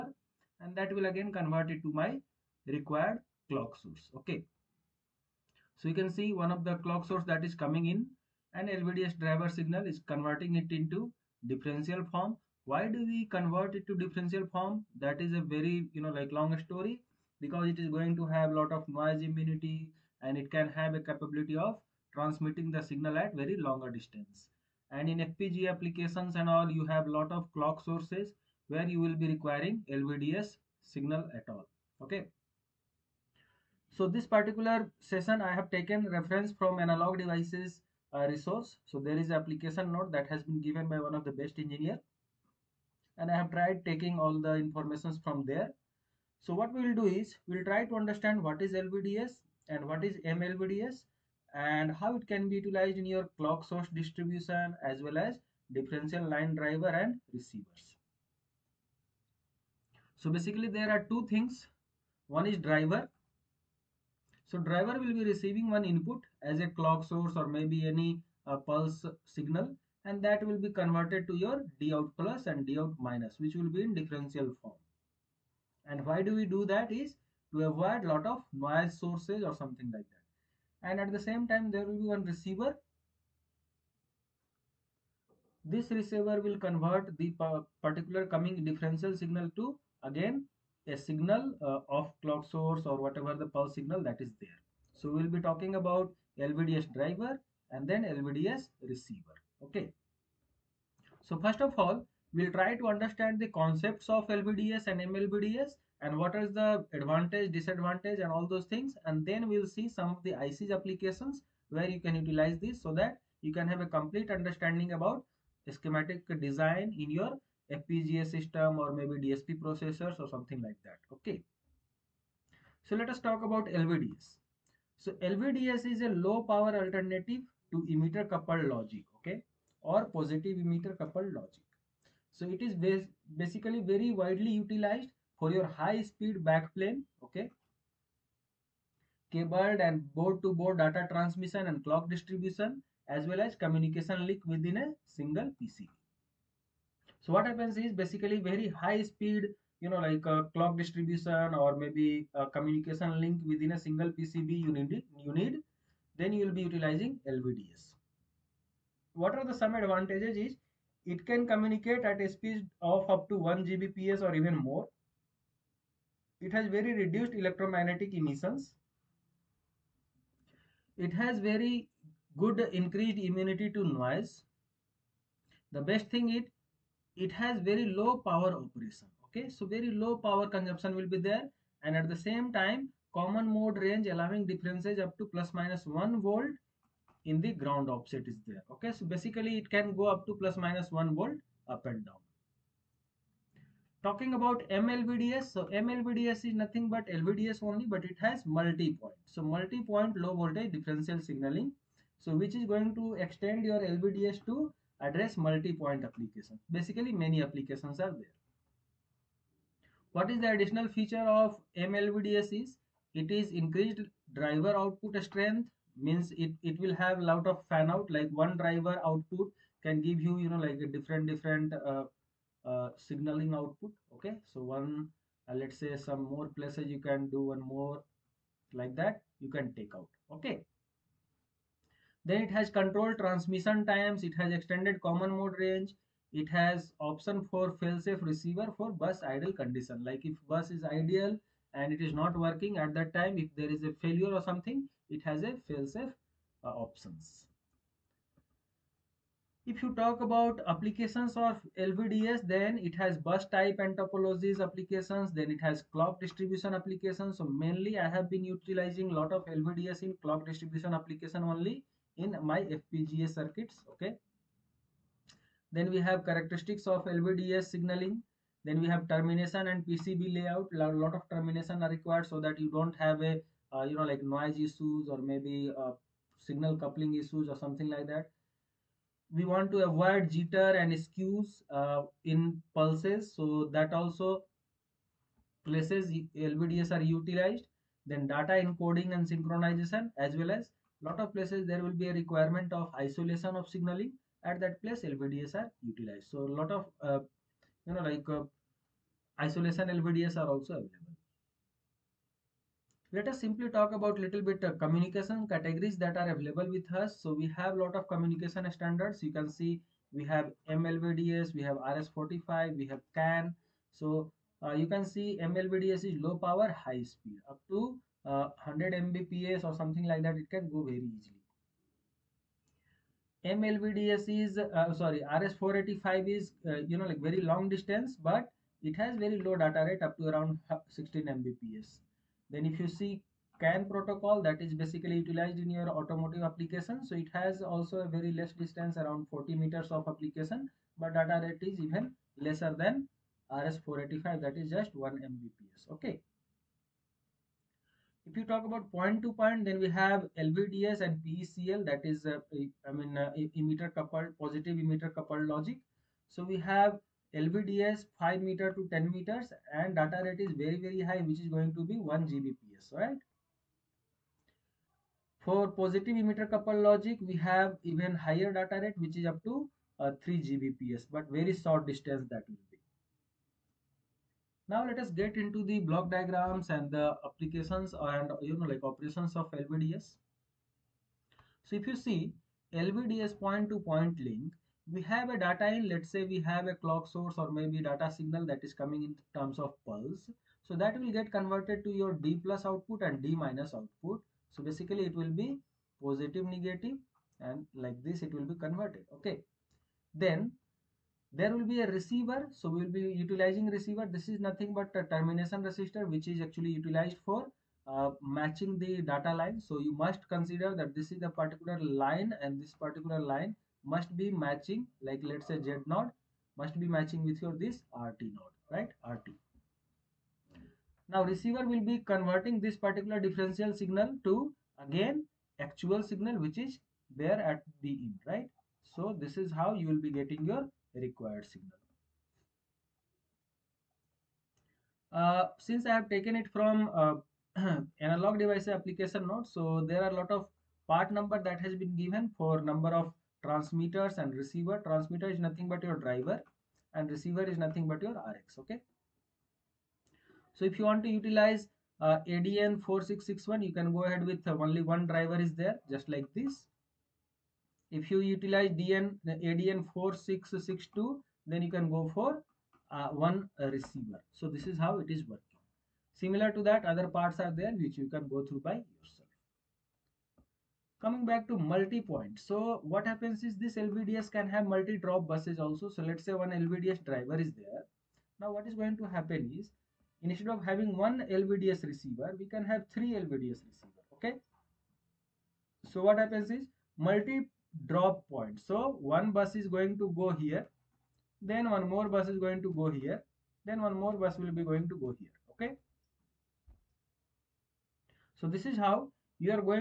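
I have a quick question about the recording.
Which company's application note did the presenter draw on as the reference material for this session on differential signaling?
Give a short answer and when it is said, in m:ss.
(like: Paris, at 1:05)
Analog Devices, at 0:36.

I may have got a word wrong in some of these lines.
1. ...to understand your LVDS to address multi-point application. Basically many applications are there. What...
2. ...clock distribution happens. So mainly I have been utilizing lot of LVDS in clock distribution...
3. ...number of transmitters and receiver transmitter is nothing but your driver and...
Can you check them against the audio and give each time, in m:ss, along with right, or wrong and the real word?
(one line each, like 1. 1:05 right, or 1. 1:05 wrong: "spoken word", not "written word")
1. 3:22 wrong: "extend", not "understand"
2. 4:15 wrong: "applications", not "happens"
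3. 7:22 right.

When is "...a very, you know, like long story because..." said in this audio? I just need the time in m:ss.
0:15.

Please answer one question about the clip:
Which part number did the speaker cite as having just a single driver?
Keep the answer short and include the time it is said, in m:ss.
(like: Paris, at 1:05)
ADN4661, at 7:32.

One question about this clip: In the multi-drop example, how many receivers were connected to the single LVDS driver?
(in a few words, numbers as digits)
3.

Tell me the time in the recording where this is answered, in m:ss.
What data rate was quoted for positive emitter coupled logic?
6:10.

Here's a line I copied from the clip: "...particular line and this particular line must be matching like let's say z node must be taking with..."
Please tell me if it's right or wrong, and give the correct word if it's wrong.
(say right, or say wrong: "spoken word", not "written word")
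wrong: "matching", not "taking".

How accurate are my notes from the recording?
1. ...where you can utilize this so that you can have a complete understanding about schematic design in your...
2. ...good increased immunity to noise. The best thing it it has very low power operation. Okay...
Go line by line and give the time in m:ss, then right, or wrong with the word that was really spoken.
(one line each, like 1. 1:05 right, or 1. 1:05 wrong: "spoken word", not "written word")
1. 1:51 right
2. 2:52 right.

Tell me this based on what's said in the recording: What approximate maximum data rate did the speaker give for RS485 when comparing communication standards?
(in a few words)
16 Mbps.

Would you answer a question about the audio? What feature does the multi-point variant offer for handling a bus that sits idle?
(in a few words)
Failsafe receiver.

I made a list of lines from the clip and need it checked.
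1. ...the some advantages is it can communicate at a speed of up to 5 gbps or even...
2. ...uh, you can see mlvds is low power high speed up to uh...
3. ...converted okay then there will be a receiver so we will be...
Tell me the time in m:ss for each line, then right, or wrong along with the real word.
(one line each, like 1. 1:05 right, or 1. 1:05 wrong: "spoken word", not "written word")
1. 2:39 wrong: "1", not "5"
2. 5:14 right
3. 6:38 right.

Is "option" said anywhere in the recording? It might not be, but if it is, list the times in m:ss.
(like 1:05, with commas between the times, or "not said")
3:57, 4:06.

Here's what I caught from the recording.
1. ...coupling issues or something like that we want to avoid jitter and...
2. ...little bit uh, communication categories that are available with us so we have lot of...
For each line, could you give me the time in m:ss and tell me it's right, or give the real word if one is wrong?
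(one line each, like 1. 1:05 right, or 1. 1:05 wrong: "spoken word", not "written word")
1. 4:36 right
2. 5:04 right.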